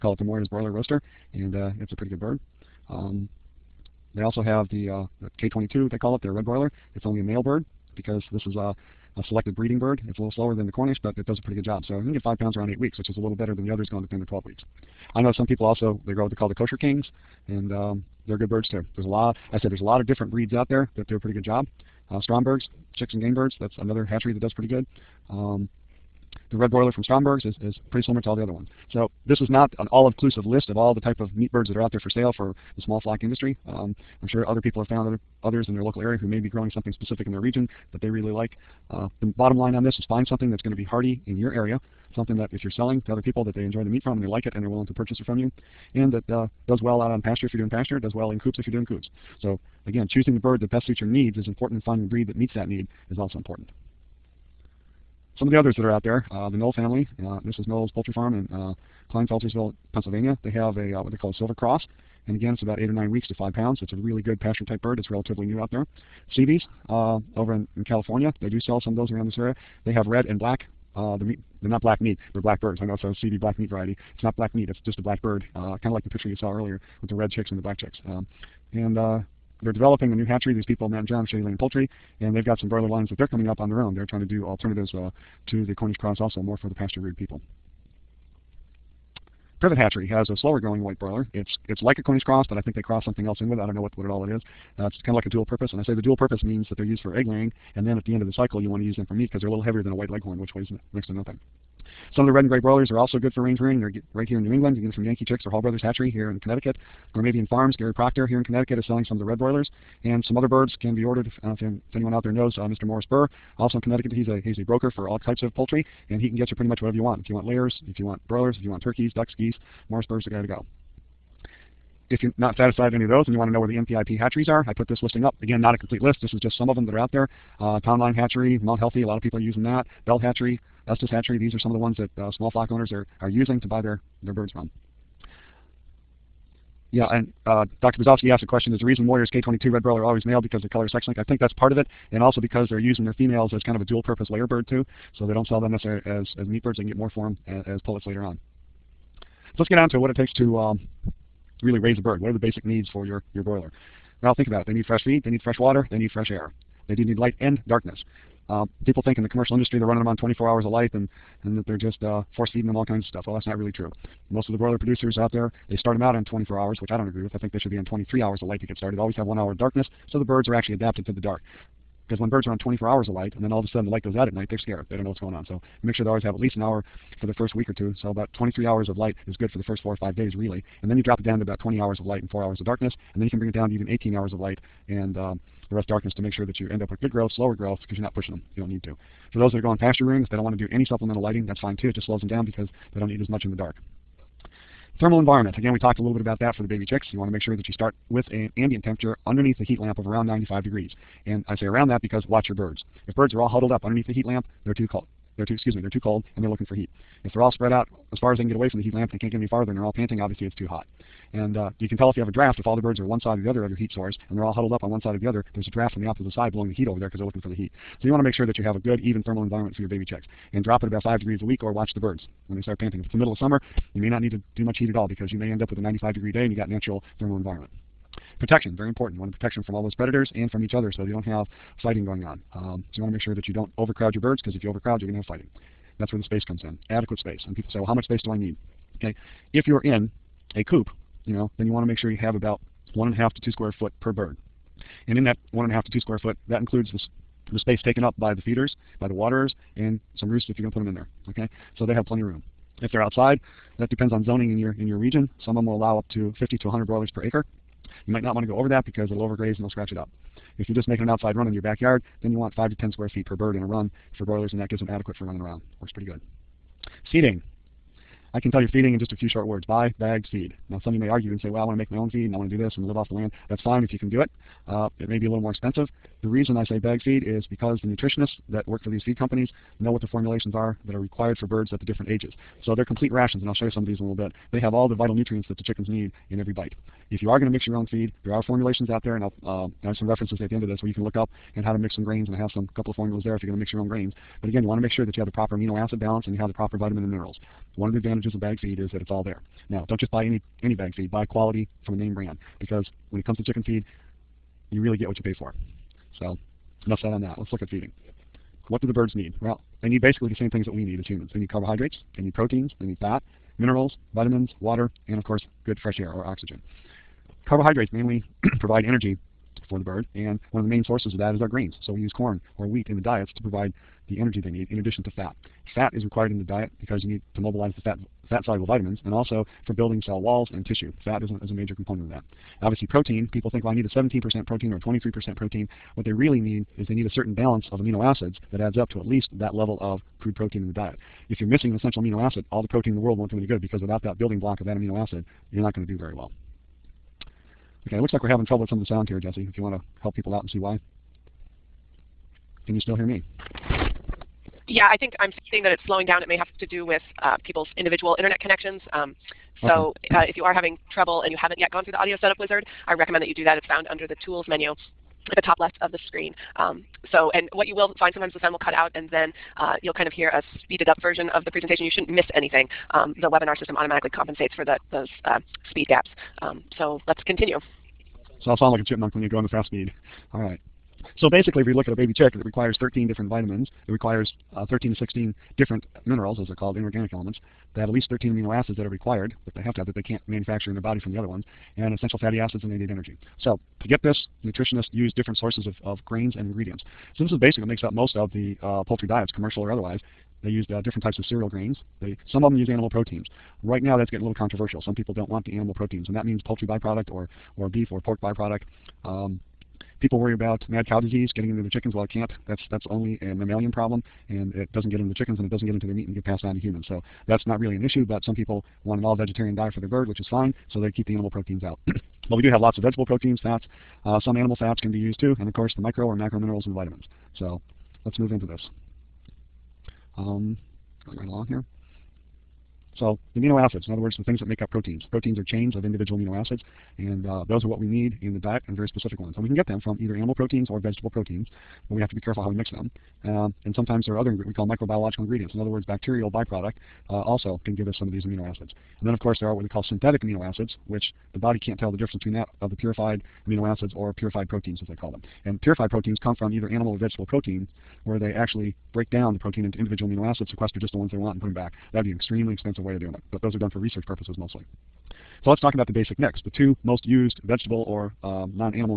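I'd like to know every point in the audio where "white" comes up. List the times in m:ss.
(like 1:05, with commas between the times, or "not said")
1:30, 1:39.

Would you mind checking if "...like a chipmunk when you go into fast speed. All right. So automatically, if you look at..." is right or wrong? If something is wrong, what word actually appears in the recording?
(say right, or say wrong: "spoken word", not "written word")
wrong: "basically", not "automatically".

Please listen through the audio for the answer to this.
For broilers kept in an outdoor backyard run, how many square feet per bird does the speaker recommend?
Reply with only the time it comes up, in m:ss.
4:22.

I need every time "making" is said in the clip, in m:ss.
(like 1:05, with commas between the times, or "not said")
4:20.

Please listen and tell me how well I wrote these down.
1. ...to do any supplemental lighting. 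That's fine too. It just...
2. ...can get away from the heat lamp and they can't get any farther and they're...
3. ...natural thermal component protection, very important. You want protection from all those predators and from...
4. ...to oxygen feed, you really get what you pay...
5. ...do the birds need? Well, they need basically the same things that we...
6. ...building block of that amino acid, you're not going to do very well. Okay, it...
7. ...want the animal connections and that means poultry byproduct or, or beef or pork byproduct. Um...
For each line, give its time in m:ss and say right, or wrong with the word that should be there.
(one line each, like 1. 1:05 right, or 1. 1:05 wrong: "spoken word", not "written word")
1. 3:10 right
2. 3:28 right
3. 3:46 wrong: "environment", not "component"
4. 5:03 wrong: "chicken", not "oxygen"
5. 5:08 right
6. 5:44 right
7. 6:45 wrong: "proteins", not "connections".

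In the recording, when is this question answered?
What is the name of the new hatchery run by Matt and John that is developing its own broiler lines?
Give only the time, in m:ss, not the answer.
1:21.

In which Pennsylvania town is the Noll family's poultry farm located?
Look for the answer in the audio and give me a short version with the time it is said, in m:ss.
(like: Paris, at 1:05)
Kleinfeltersville, at 0:59.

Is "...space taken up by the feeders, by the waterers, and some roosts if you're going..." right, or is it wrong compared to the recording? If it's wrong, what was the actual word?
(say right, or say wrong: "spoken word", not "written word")
right.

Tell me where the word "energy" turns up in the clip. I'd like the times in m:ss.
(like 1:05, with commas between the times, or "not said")
5:18, 5:24, 6:32.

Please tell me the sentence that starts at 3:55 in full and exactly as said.
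That's where the space comes in, adequate space.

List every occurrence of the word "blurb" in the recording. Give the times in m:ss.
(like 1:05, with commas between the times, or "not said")
not said.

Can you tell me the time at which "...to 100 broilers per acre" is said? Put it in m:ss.
4:16.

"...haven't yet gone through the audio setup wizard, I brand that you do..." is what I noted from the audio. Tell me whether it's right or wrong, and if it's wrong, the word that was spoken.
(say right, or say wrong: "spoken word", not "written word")
wrong: "recommend", not "brand".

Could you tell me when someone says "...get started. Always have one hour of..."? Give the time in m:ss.
2:48.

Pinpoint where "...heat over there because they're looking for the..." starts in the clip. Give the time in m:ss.
3:36.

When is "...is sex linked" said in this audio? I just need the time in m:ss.
2:20.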